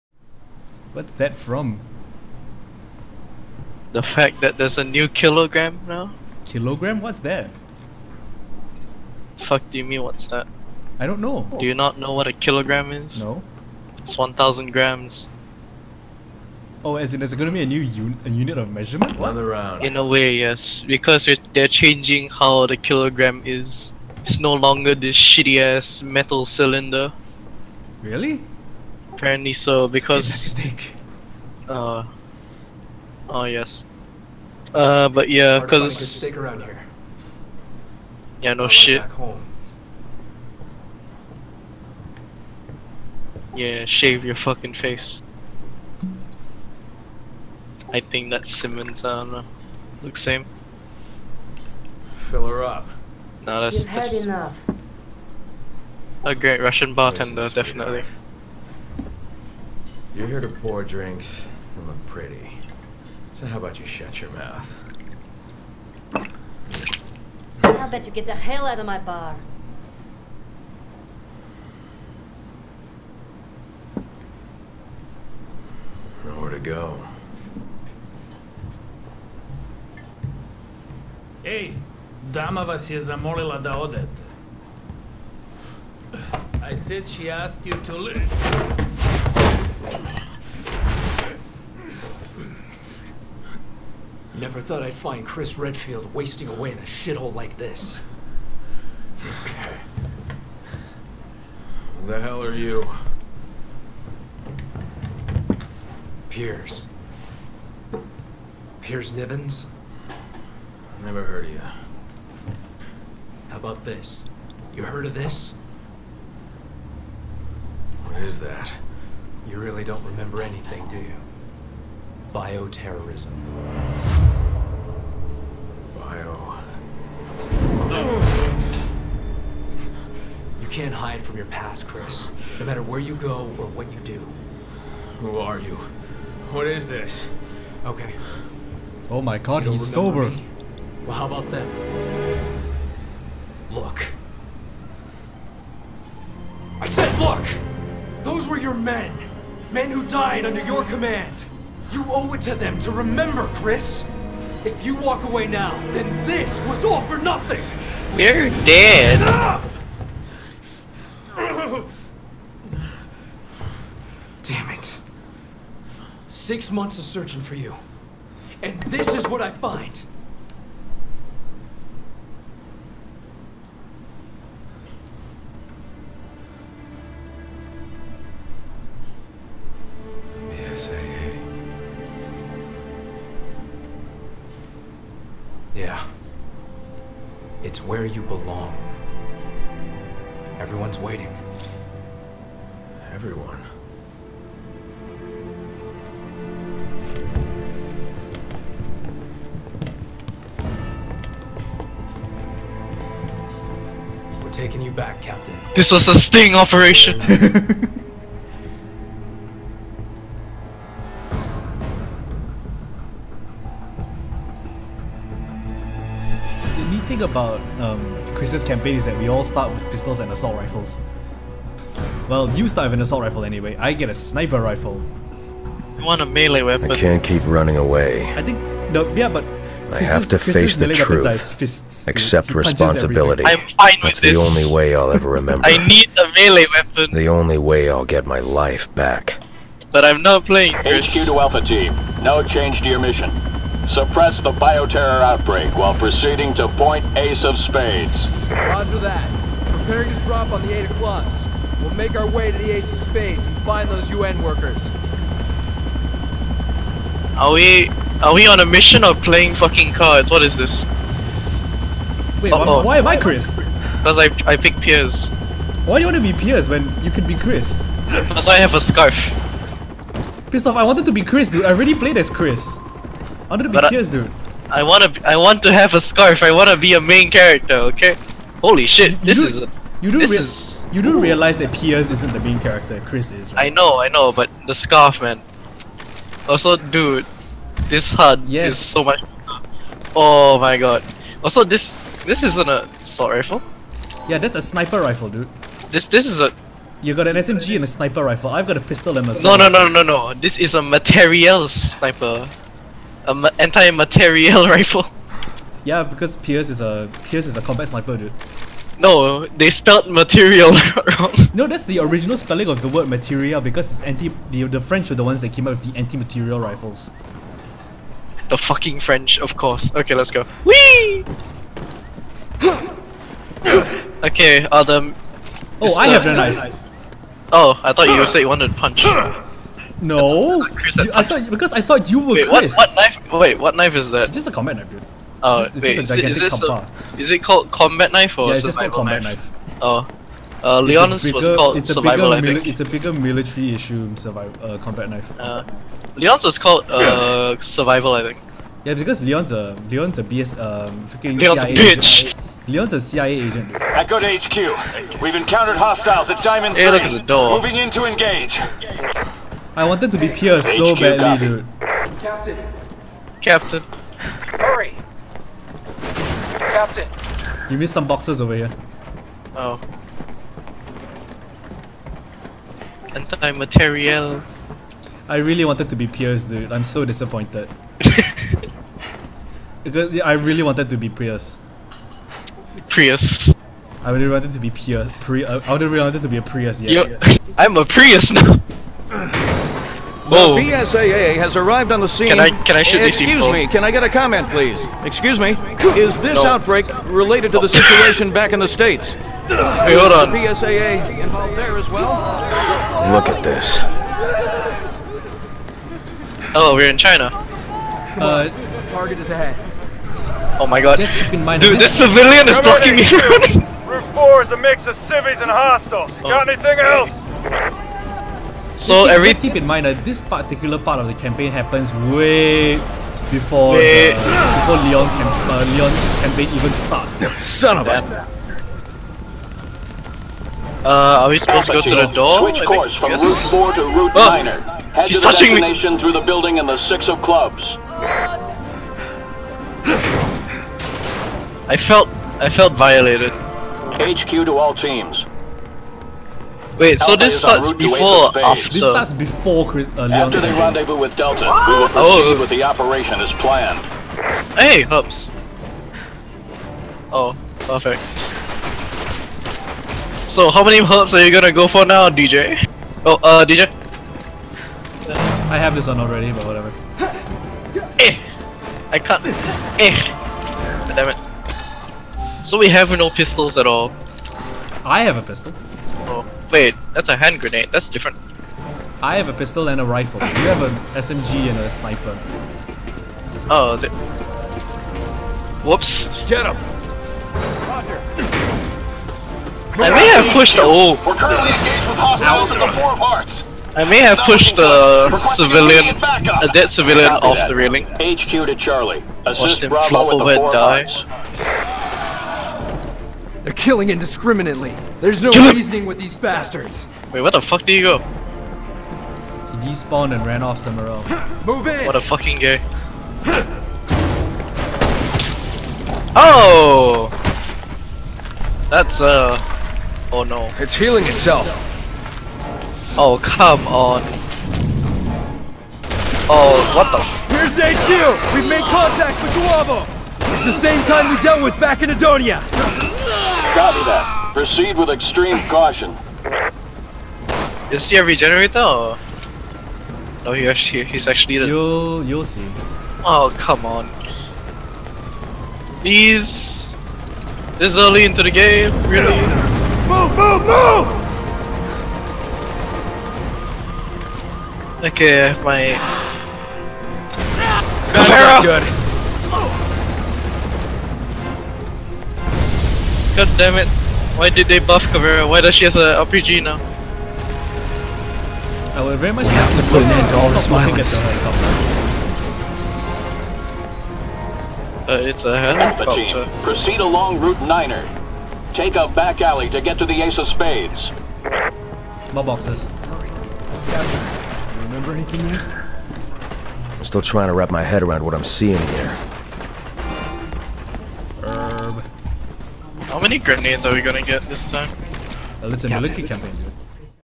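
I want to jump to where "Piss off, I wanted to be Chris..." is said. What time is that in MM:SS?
04:30.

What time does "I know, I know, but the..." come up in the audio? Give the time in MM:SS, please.
04:43.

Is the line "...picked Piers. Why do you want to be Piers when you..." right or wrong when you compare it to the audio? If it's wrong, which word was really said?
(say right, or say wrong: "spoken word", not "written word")
right.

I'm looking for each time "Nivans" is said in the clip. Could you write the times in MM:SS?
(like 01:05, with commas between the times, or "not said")
01:49.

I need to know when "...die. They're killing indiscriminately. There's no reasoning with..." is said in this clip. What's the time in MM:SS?
08:20.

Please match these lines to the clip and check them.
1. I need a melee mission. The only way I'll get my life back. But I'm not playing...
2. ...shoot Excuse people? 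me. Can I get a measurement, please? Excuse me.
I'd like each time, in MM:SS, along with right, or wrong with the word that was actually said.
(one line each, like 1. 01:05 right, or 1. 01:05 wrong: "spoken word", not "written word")
1. 03:55 wrong: "weapon", not "mission"
2. 06:32 wrong: "comment", not "measurement".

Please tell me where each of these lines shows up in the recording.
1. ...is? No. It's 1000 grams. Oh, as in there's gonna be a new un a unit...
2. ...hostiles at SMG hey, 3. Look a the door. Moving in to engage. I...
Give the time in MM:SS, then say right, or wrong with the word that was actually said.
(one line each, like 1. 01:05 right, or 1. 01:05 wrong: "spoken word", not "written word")
1. 00:12 right
2. 05:55 wrong: "Diamond", not "SMG".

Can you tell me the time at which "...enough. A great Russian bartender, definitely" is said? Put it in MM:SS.
00:54.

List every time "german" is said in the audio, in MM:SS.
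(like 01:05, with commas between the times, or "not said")
not said.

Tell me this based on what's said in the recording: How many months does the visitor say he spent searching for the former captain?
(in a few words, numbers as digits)
6.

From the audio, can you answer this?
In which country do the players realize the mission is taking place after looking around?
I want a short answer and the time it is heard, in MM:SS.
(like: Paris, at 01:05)
China, at 06:46.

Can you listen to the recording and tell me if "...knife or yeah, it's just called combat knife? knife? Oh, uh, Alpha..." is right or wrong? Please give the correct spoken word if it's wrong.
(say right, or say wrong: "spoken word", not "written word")
wrong: "Leonis", not "Alpha".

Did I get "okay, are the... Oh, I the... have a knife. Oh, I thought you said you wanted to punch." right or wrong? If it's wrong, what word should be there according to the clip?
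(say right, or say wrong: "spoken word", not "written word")
right.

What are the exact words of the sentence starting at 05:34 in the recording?
It's just a combat knife, dude.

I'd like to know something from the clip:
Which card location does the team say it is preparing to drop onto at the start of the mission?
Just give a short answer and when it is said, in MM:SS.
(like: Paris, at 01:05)
eight of clubs, at 04:10.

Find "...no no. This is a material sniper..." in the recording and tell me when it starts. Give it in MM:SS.
04:59.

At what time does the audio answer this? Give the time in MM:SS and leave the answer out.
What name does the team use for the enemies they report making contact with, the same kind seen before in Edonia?
08:49.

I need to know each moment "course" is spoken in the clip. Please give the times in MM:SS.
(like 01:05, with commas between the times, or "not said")
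05:19, 07:12.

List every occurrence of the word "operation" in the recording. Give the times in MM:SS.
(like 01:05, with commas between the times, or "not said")
03:26, 07:32.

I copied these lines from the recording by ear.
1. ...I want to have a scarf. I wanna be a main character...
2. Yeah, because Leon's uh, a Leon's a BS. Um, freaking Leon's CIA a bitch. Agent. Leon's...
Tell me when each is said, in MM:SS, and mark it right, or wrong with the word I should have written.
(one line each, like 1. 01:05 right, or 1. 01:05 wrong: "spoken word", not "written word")
1. 04:35 right
2. 05:48 right.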